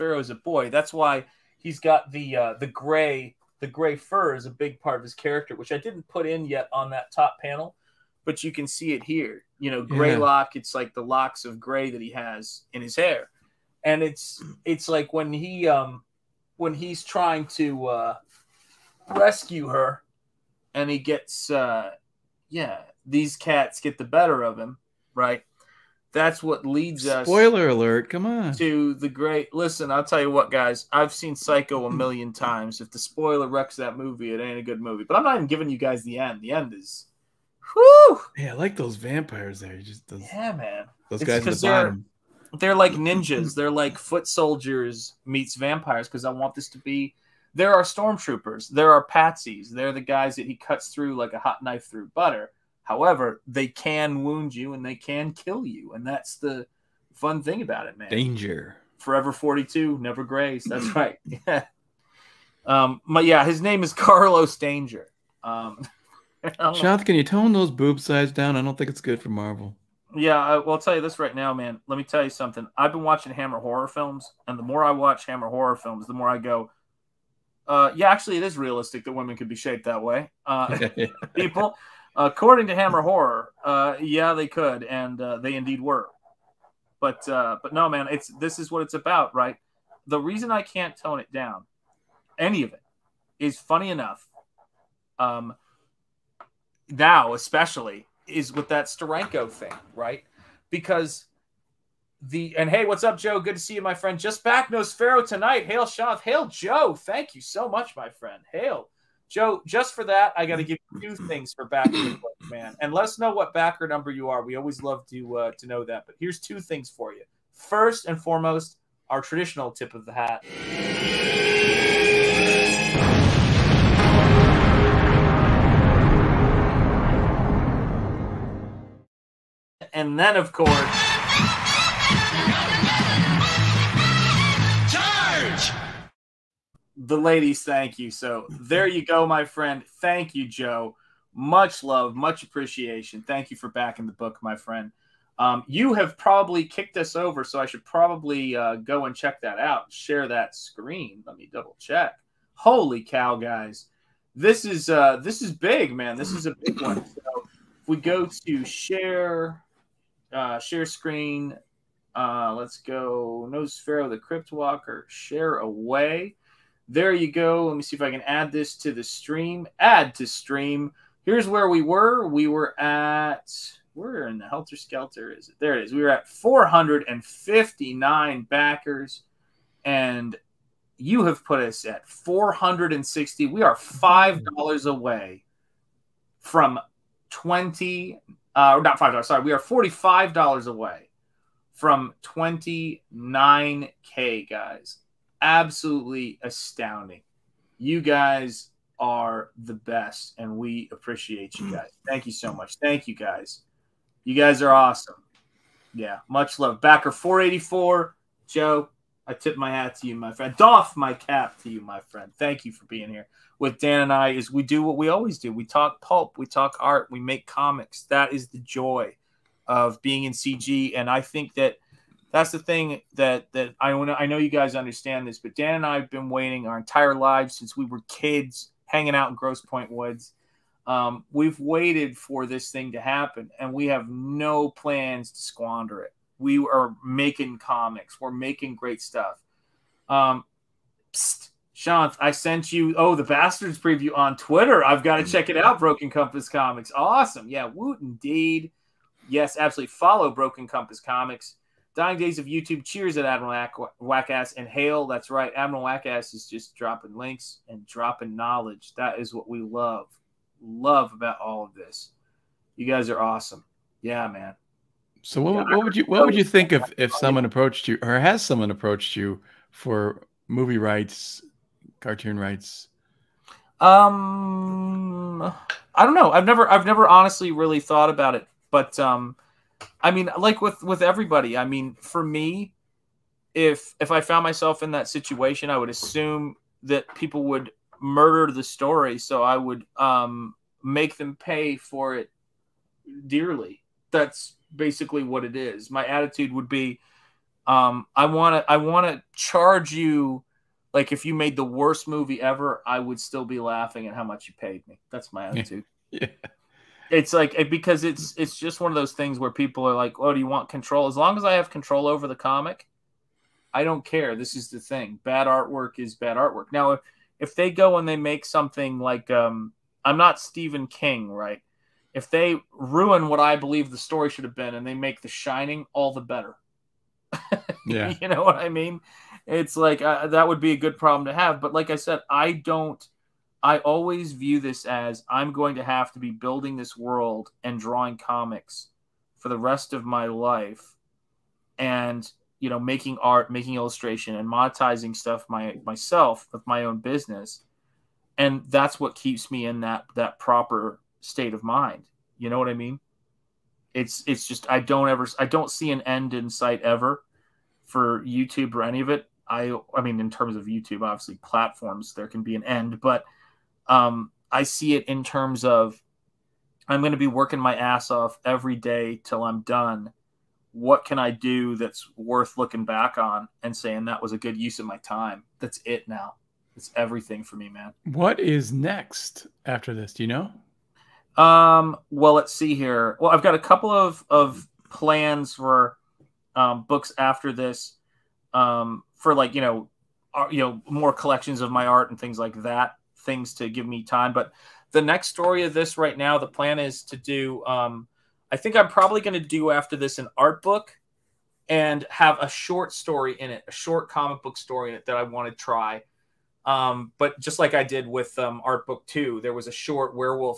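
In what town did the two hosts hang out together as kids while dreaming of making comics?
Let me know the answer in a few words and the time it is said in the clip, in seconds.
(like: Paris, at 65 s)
Grosse Pointe Woods, at 229 s.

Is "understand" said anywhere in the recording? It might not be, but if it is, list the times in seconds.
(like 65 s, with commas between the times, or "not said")
224 s.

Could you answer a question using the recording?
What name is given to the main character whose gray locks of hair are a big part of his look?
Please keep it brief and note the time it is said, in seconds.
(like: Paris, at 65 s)
Carlos Danger, at 63 s.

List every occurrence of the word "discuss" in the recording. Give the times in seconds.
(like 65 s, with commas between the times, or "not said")
not said.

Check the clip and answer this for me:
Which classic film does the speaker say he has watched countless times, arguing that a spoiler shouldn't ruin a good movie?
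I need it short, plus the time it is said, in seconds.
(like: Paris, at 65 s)
Psycho, at 31 s.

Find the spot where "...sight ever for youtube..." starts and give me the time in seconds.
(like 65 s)
356 s.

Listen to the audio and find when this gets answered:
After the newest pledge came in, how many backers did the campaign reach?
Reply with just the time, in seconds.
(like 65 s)
182 s.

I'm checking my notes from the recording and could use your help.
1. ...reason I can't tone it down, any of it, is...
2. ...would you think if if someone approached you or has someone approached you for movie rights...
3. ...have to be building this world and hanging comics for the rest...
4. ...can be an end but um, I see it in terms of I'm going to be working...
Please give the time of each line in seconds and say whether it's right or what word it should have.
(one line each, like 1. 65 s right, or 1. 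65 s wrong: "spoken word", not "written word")
1. 90 s right
2. 266 s right
3. 335 s wrong: "drawing", not "hanging"
4. 362 s right.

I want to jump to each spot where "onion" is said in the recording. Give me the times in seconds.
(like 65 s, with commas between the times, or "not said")
not said.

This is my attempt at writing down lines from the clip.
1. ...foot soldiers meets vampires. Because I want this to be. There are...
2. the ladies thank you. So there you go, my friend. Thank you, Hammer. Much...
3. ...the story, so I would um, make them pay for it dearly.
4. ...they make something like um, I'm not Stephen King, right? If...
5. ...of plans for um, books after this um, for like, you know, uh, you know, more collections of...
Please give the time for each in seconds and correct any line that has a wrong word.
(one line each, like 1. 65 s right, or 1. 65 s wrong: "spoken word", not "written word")
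1. 43 s right
2. 136 s wrong: "Joe", not "Hammer"
3. 288 s right
4. 318 s right
5. 384 s right.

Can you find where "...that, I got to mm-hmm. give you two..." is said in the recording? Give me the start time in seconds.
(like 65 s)
110 s.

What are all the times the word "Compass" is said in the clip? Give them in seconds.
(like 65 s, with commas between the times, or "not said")
246 s, 250 s.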